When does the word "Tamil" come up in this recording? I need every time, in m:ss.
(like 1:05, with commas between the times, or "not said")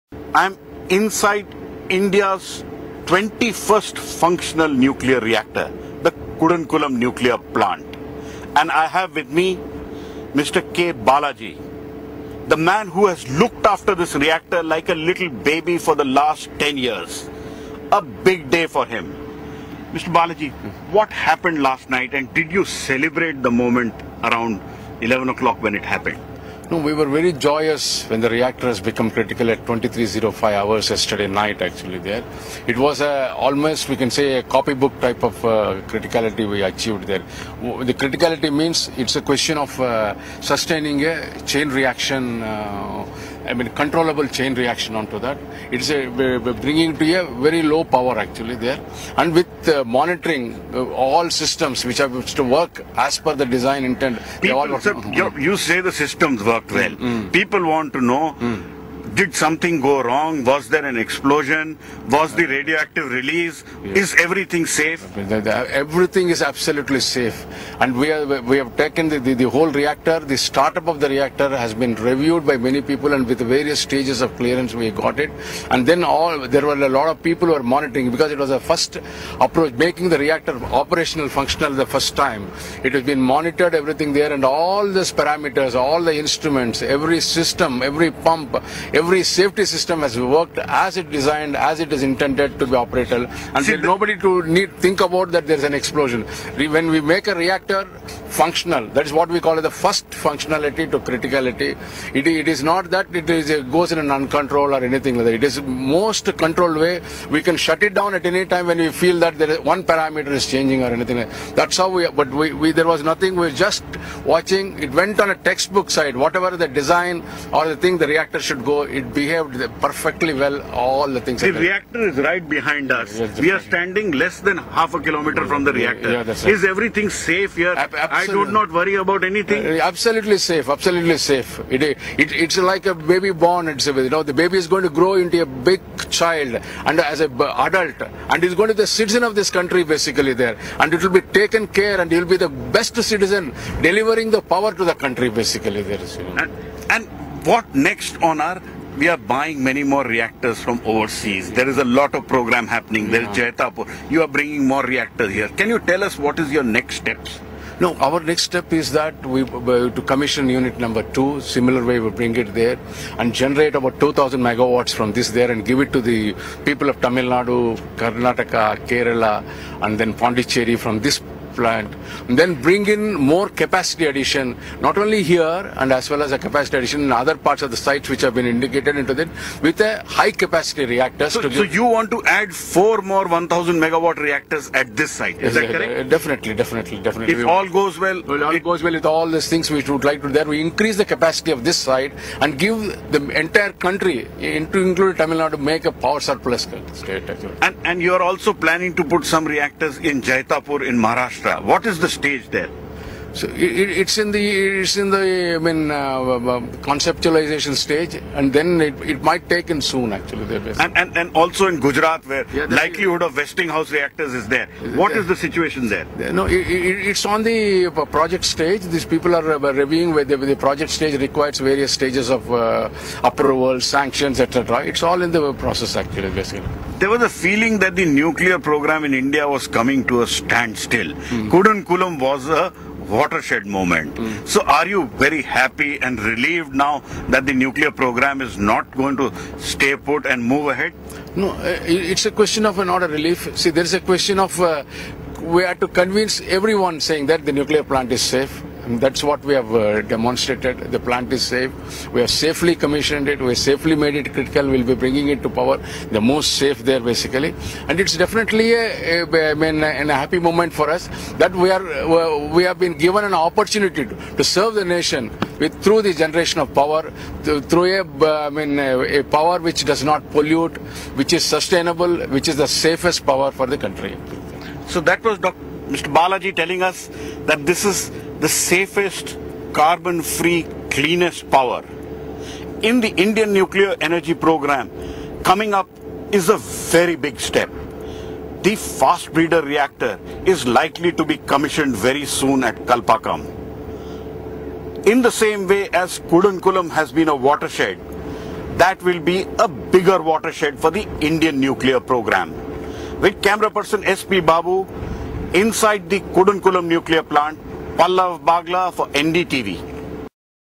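2:47, 3:15.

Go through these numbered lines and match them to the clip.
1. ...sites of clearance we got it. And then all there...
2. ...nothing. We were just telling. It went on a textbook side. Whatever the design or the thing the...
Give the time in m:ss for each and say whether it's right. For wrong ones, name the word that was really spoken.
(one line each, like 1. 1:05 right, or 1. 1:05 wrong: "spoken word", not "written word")
1. 1:13 wrong: "stages", not "sites"
2. 1:53 wrong: "watching", not "telling".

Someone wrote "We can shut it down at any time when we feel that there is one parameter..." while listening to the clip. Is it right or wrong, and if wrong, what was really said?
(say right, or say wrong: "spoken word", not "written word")
right.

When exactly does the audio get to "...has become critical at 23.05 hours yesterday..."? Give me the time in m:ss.
0:28.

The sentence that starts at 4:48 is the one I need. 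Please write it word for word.
The fast breeder reactor is likely to be commissioned very soon at Kalpakkam.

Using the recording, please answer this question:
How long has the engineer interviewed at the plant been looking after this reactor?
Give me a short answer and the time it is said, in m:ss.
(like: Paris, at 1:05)
10 years, at 0:16.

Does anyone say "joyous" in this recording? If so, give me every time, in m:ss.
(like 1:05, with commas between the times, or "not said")
0:27.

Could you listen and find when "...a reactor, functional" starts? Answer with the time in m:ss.
1:37.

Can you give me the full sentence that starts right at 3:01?
So, so you want to add four more 1000 megawatt reactors at this site, is yes, that correct?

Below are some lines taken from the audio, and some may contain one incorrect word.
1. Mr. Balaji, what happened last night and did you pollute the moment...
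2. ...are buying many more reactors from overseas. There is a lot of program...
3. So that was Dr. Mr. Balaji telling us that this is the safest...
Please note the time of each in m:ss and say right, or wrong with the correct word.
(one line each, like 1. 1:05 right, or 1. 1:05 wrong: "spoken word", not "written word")
1. 0:19 wrong: "celebrate", not "pollute"
2. 2:29 right
3. 4:34 right.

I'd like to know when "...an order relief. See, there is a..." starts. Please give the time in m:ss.
4:02.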